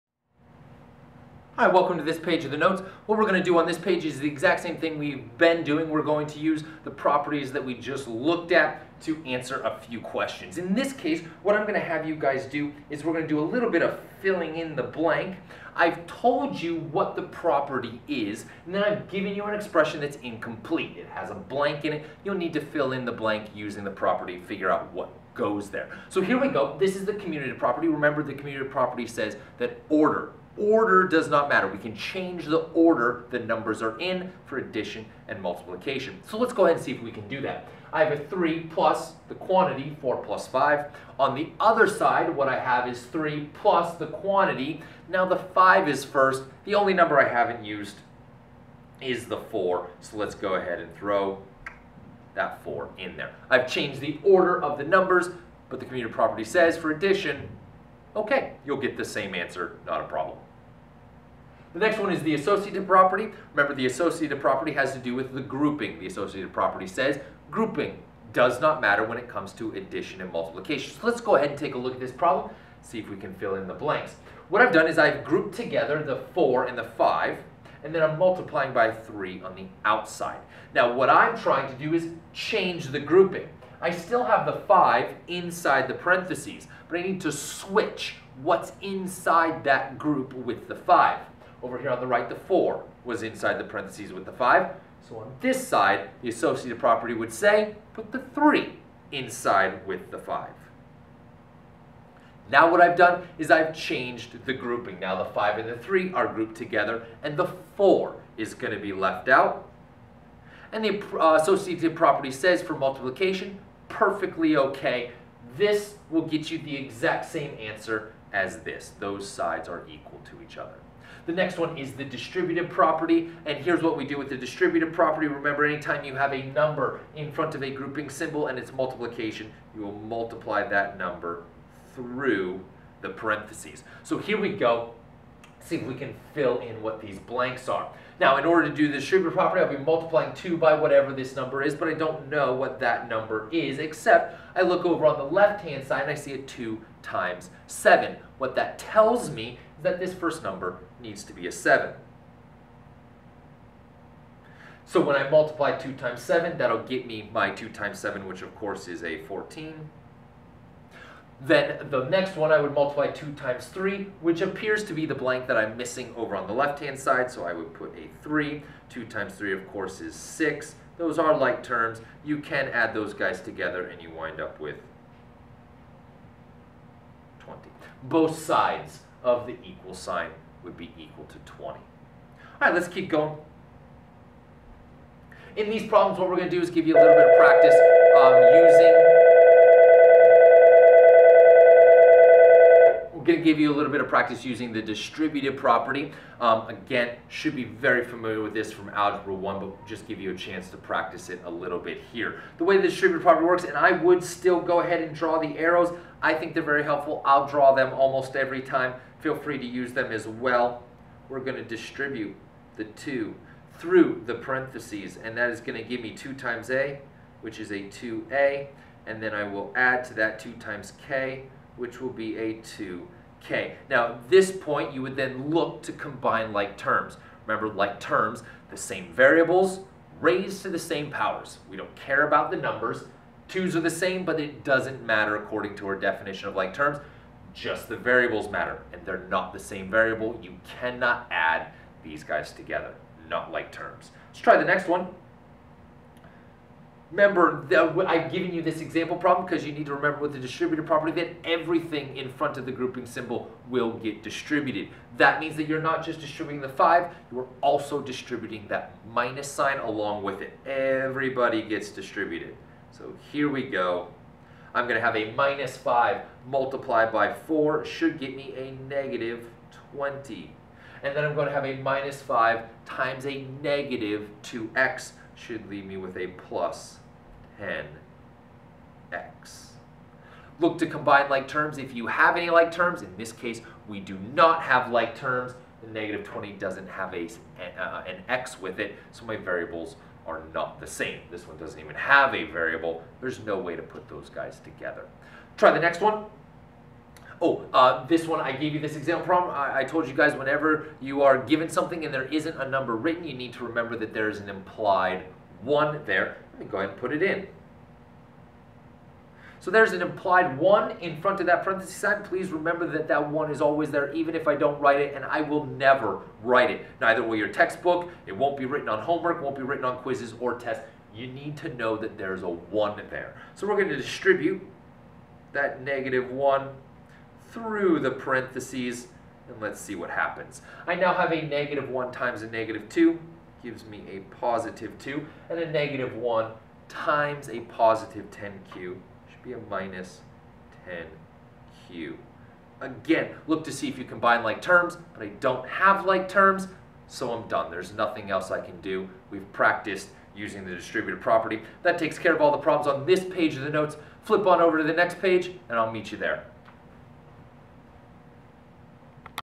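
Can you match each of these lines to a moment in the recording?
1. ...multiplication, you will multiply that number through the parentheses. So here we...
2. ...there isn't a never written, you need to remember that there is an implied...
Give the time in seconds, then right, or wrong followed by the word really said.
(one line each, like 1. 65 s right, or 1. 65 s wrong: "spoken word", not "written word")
1. 128 s right
2. 302 s wrong: "number", not "never".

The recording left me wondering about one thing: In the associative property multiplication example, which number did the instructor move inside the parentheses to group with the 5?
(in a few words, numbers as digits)
3.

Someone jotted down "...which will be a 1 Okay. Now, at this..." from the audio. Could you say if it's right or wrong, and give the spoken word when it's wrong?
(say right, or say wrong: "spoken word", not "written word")
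wrong: "2", not "1".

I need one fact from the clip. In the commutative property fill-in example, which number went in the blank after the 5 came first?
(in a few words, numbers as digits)
4.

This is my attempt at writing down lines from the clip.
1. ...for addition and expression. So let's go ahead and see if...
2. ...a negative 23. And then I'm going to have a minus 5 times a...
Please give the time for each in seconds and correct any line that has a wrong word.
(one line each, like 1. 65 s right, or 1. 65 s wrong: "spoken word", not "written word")
1. 34 s wrong: "multiplication", not "expression"
2. 268 s wrong: "20", not "23".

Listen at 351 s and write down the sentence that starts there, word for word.
That takes care of all the problems on this page of the notes.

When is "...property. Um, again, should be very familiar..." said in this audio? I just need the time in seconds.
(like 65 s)
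195 s.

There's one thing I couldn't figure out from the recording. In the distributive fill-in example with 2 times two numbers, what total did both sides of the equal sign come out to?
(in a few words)
20.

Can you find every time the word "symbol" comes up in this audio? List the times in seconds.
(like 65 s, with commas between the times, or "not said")
128 s, 253 s.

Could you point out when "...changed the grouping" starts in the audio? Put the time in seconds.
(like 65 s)
103 s.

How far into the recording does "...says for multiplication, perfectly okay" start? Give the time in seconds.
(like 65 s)
112 s.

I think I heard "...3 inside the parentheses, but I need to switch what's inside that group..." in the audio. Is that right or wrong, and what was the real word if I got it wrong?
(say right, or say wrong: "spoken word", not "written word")
wrong: "5", not "3".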